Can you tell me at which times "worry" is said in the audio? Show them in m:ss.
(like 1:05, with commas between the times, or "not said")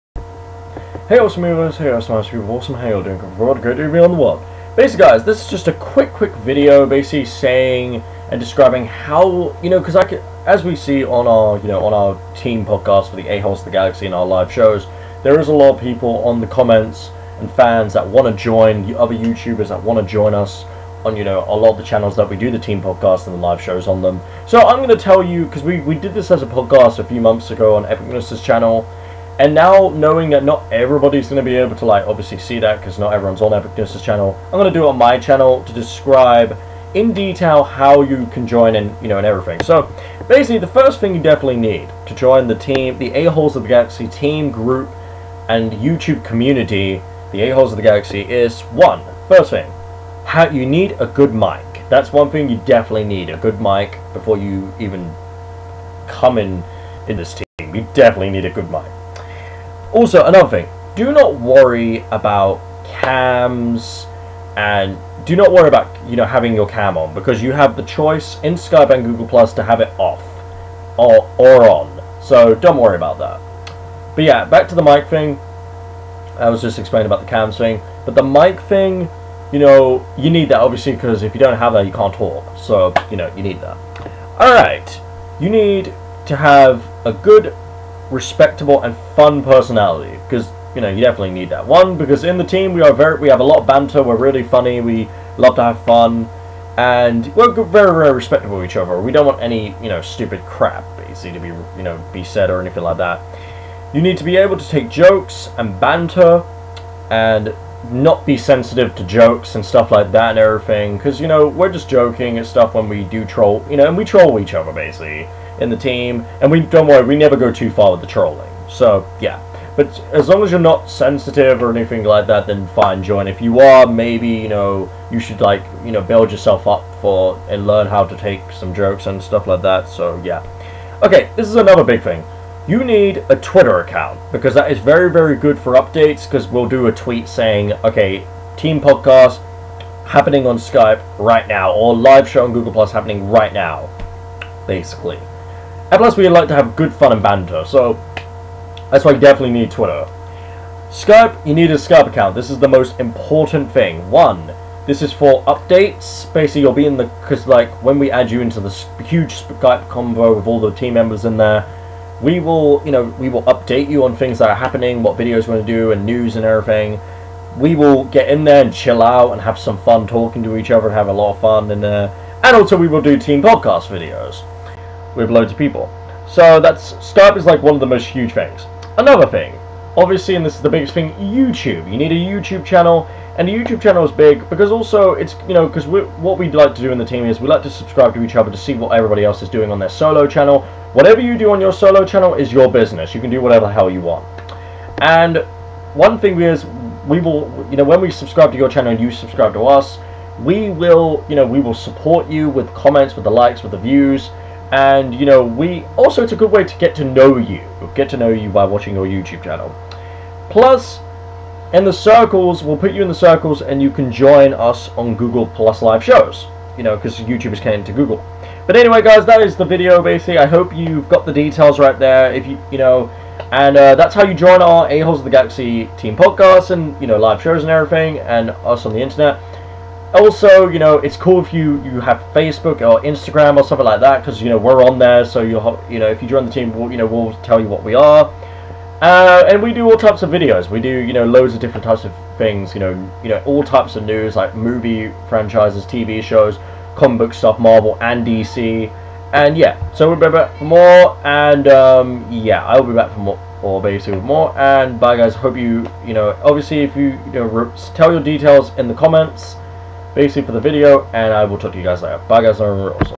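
1:01, 1:05, 1:12, 1:56.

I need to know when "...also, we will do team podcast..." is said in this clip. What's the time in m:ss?
2:52.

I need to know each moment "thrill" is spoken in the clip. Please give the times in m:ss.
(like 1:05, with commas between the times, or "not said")
not said.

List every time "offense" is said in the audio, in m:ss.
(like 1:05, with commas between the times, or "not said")
not said.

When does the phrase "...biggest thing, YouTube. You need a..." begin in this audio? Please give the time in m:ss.
3:00.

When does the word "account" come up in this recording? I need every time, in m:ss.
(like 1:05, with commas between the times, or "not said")
2:13, 2:32.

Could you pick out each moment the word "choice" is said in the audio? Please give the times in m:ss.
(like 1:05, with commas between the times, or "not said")
1:07.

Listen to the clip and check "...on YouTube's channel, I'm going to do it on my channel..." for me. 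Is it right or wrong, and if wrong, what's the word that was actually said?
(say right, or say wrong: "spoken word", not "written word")
wrong: "Epicness", not "YouTube".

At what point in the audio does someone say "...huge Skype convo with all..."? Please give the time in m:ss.
2:39.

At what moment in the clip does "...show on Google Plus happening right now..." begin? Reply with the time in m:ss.
2:22.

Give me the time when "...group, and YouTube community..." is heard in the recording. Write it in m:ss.
0:44.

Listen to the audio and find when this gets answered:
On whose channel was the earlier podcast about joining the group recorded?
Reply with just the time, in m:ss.
0:27.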